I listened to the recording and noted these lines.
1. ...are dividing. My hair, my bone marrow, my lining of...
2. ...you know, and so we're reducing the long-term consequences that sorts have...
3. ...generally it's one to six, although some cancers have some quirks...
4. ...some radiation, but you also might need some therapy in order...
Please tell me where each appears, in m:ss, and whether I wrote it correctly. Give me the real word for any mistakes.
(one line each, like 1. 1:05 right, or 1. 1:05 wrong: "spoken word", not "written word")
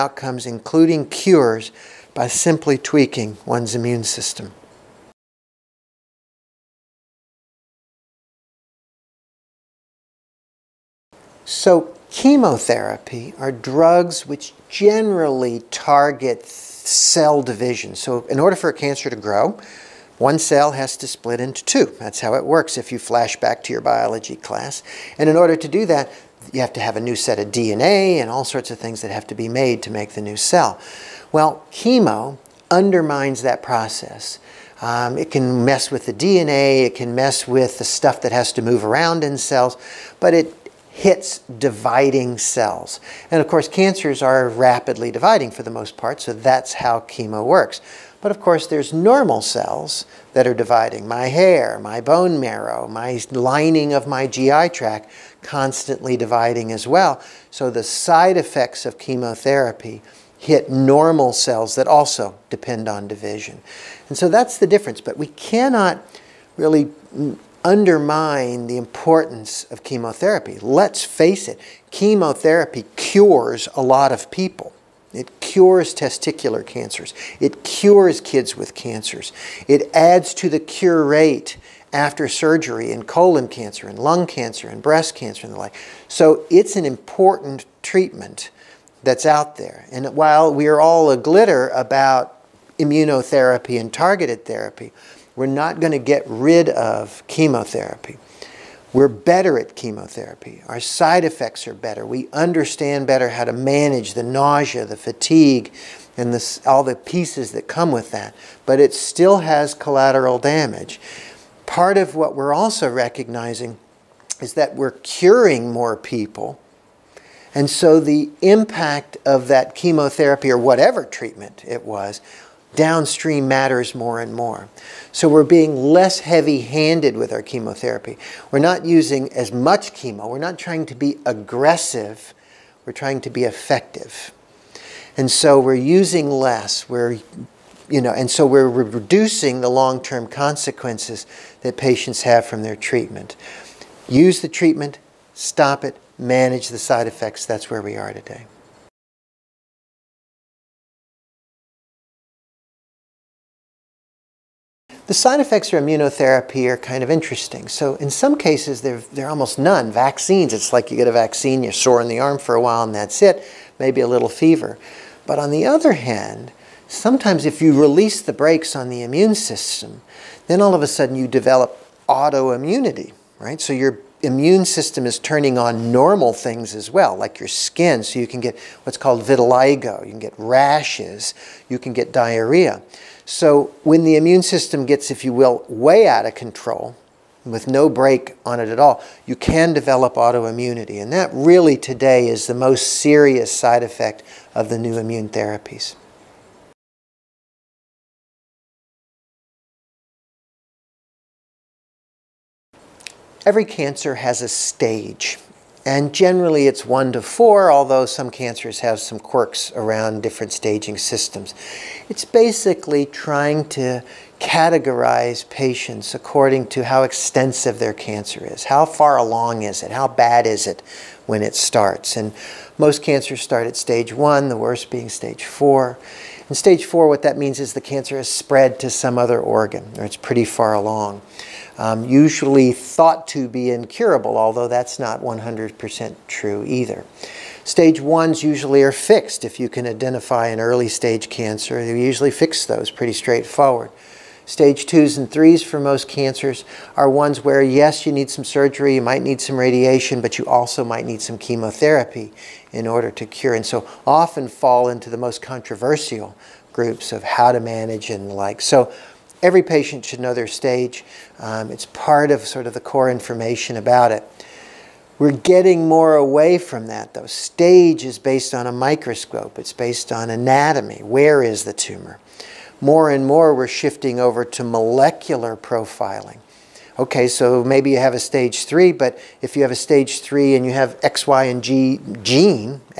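1. 0:50 right
2. 2:17 wrong: "patients", not "sorts"
3. 3:26 wrong: "four", not "six"
4. 4:09 wrong: "chemotherapy", not "therapy".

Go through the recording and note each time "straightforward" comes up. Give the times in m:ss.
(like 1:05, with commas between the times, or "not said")
4:03.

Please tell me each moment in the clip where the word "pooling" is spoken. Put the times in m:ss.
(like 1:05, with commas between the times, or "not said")
not said.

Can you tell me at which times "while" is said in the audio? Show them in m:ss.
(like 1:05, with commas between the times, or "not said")
1:30, 2:42.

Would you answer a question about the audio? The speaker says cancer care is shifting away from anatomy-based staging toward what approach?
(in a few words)
Molecular profiling.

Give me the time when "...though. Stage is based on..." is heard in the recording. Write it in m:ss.
4:27.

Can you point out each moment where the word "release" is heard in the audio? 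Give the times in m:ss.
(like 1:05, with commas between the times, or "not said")
2:47.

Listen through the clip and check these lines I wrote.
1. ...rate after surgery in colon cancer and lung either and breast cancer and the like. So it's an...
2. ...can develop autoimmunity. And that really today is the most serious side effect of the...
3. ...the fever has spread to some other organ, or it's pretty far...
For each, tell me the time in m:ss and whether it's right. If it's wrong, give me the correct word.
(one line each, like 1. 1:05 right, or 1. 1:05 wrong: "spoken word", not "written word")
1. 1:21 wrong: "cancer", not "either"
2. 3:09 right
3. 3:47 wrong: "cancer", not "fever".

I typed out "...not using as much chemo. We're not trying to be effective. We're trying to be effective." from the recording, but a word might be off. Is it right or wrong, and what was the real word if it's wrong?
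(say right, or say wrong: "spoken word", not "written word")
wrong: "aggressive", not "effective".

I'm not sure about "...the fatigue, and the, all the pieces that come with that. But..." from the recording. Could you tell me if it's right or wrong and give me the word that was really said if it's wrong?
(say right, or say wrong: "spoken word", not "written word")
right.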